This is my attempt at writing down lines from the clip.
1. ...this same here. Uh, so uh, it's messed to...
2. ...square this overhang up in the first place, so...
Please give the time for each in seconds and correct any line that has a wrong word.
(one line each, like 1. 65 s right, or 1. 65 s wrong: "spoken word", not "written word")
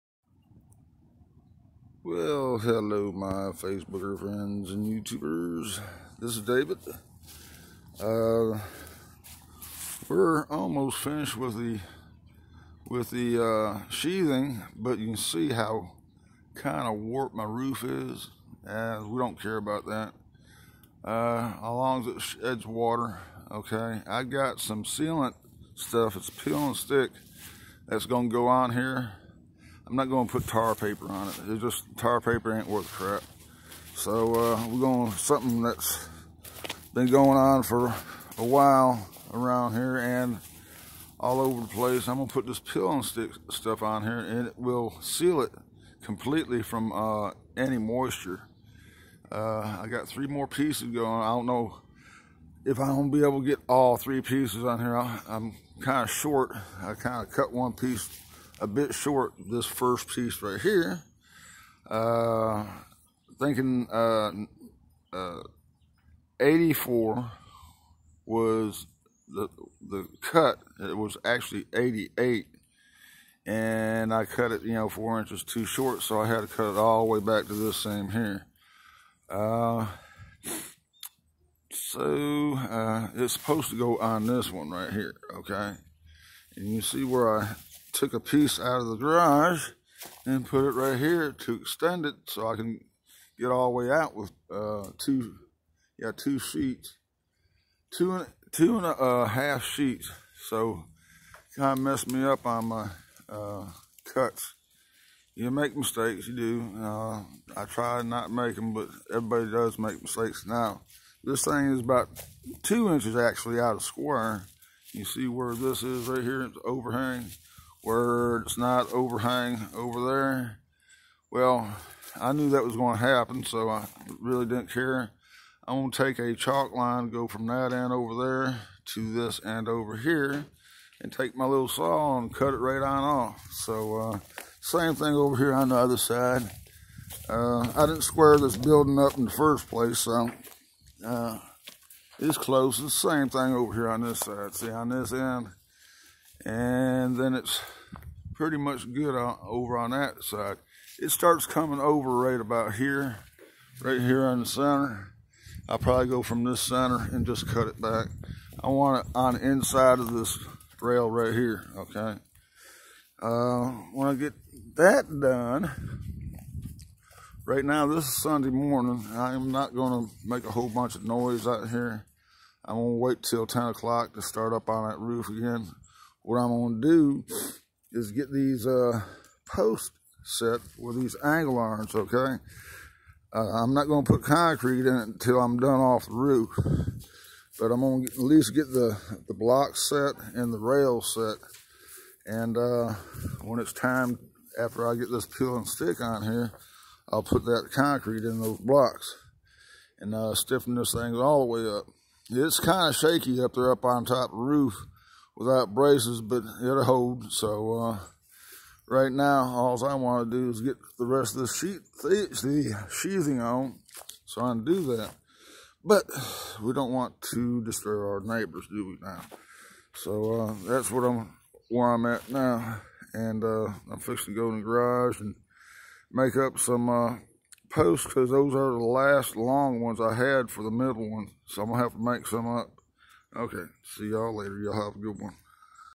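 1. 77 s wrong: "supposed", not "messed"
2. 138 s wrong: "building", not "overhang".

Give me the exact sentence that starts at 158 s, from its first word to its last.
I want it on the inside of this rail right here, okay?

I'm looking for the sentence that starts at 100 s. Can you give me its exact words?
So kind of messed me up on my uh, cuts.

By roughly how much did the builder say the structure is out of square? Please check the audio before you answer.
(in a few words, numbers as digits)
2 inches.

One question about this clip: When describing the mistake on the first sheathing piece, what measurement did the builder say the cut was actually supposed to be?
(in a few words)
88.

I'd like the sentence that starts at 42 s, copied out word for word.
I'm gonna put this peel and stick stuff on here and it will seal it completely from uh, any moisture.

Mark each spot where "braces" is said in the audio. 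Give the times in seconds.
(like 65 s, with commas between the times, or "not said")
205 s.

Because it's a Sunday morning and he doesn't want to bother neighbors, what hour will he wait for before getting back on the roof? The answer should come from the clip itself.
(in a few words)
10 o'clock.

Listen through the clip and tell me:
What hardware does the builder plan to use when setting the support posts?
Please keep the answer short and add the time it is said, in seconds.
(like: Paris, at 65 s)
angle irons, at 181 s.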